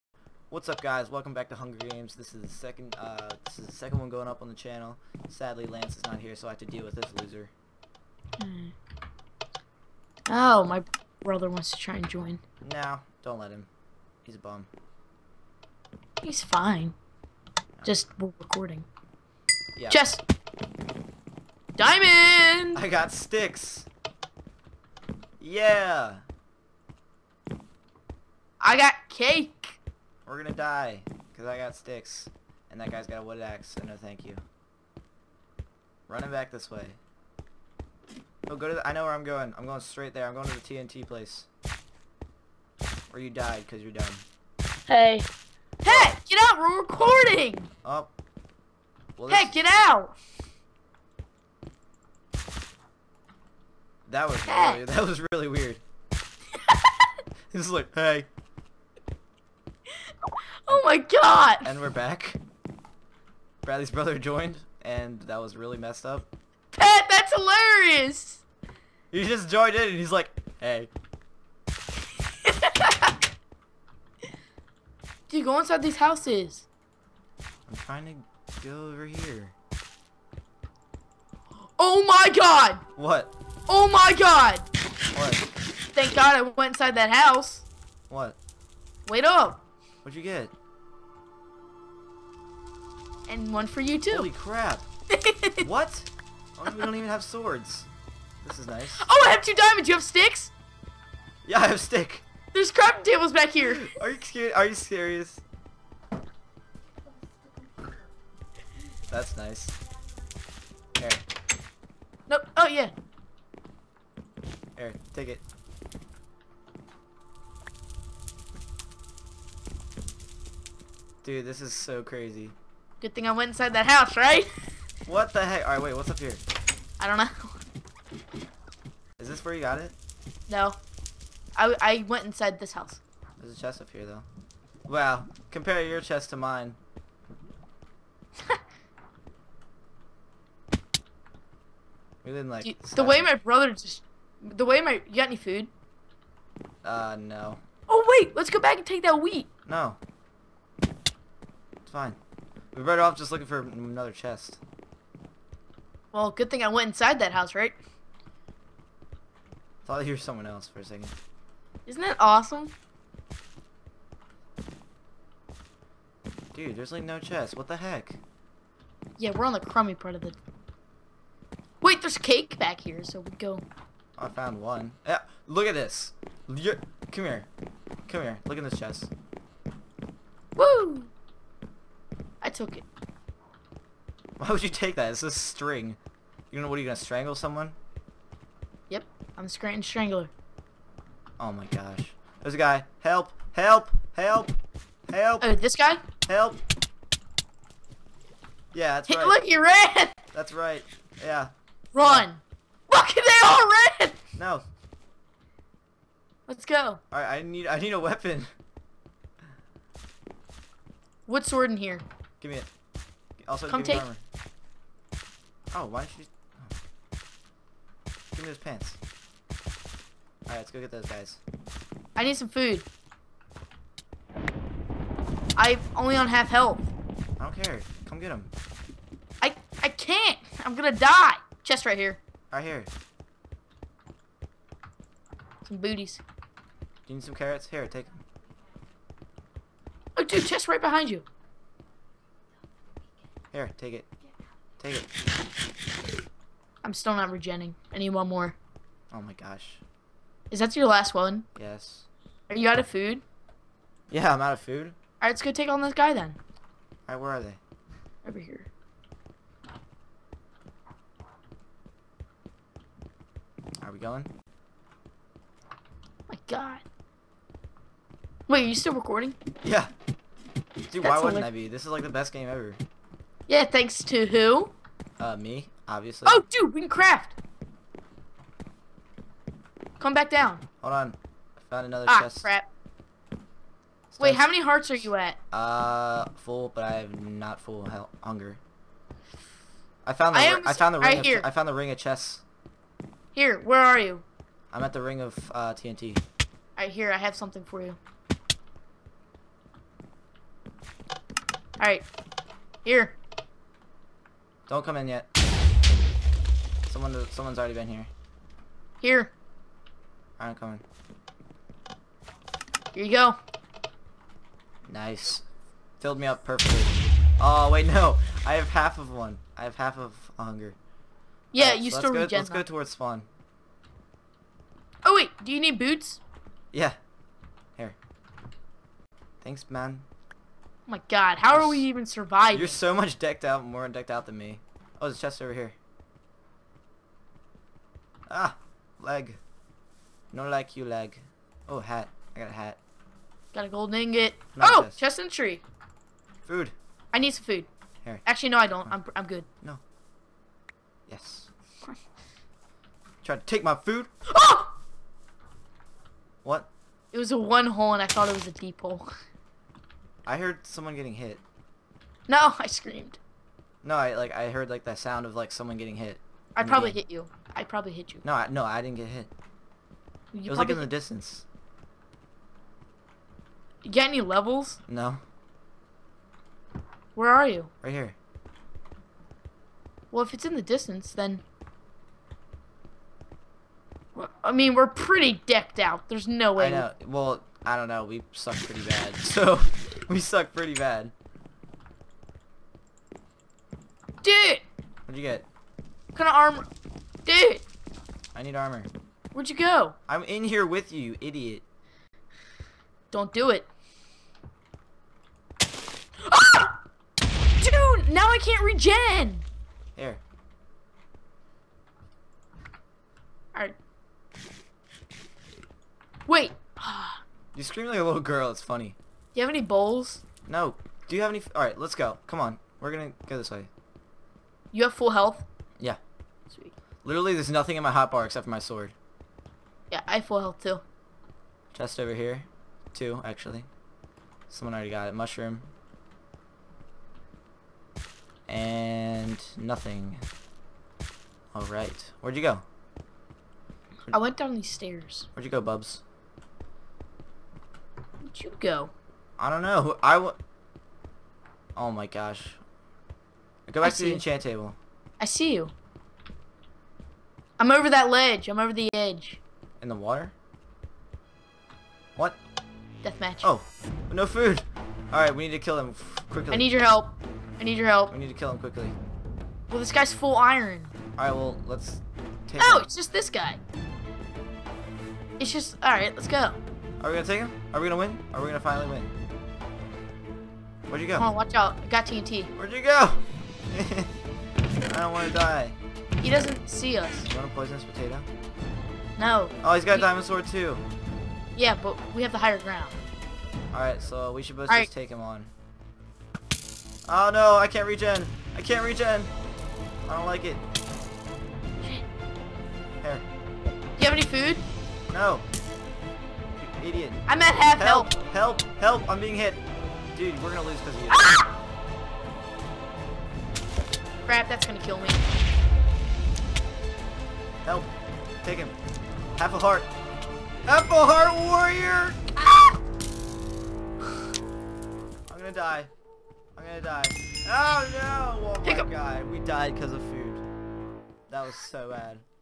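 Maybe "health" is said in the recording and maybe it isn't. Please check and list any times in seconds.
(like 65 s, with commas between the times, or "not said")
226 s, 425 s, 430 s.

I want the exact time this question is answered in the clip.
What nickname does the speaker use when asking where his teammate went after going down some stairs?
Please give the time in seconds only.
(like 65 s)
445 s.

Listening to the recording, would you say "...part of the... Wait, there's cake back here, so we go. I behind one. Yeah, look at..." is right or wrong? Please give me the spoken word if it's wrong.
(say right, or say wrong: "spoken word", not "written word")
wrong: "found", not "behind".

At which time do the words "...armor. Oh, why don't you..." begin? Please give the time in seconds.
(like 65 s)
214 s.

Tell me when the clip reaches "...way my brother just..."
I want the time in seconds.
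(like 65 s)
143 s.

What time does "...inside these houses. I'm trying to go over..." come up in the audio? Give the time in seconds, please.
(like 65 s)
75 s.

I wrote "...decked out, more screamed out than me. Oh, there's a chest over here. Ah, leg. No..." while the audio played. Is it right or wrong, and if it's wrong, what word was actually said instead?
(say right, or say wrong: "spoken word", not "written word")
wrong: "decked", not "screamed".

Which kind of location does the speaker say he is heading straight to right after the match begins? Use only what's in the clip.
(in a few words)
The TNT place.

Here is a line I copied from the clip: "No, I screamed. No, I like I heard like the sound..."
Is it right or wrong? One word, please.
right.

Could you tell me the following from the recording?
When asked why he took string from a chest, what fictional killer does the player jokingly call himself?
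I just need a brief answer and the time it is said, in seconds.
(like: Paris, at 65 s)
Scranton Strangler, at 189 s.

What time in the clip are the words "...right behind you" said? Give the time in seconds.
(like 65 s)
240 s.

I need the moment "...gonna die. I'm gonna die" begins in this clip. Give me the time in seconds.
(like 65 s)
525 s.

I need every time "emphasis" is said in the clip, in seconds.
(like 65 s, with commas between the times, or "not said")
not said.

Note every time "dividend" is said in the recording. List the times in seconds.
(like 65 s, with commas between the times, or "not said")
not said.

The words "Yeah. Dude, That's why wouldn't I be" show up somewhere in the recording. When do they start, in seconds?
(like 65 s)
269 s.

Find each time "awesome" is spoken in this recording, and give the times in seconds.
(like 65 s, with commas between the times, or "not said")
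162 s.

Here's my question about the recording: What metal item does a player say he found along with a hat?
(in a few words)
Gold ingot.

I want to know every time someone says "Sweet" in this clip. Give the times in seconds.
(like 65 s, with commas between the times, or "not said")
426 s.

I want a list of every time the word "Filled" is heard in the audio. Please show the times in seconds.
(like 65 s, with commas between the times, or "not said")
315 s.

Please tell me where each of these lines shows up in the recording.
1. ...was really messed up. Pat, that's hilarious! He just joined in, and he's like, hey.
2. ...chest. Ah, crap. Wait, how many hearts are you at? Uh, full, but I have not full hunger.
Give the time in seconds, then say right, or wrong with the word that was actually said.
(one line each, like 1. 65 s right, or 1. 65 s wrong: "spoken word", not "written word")
1. 65 s right
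2. 282 s right.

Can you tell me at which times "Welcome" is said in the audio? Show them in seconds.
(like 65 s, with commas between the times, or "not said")
1 s.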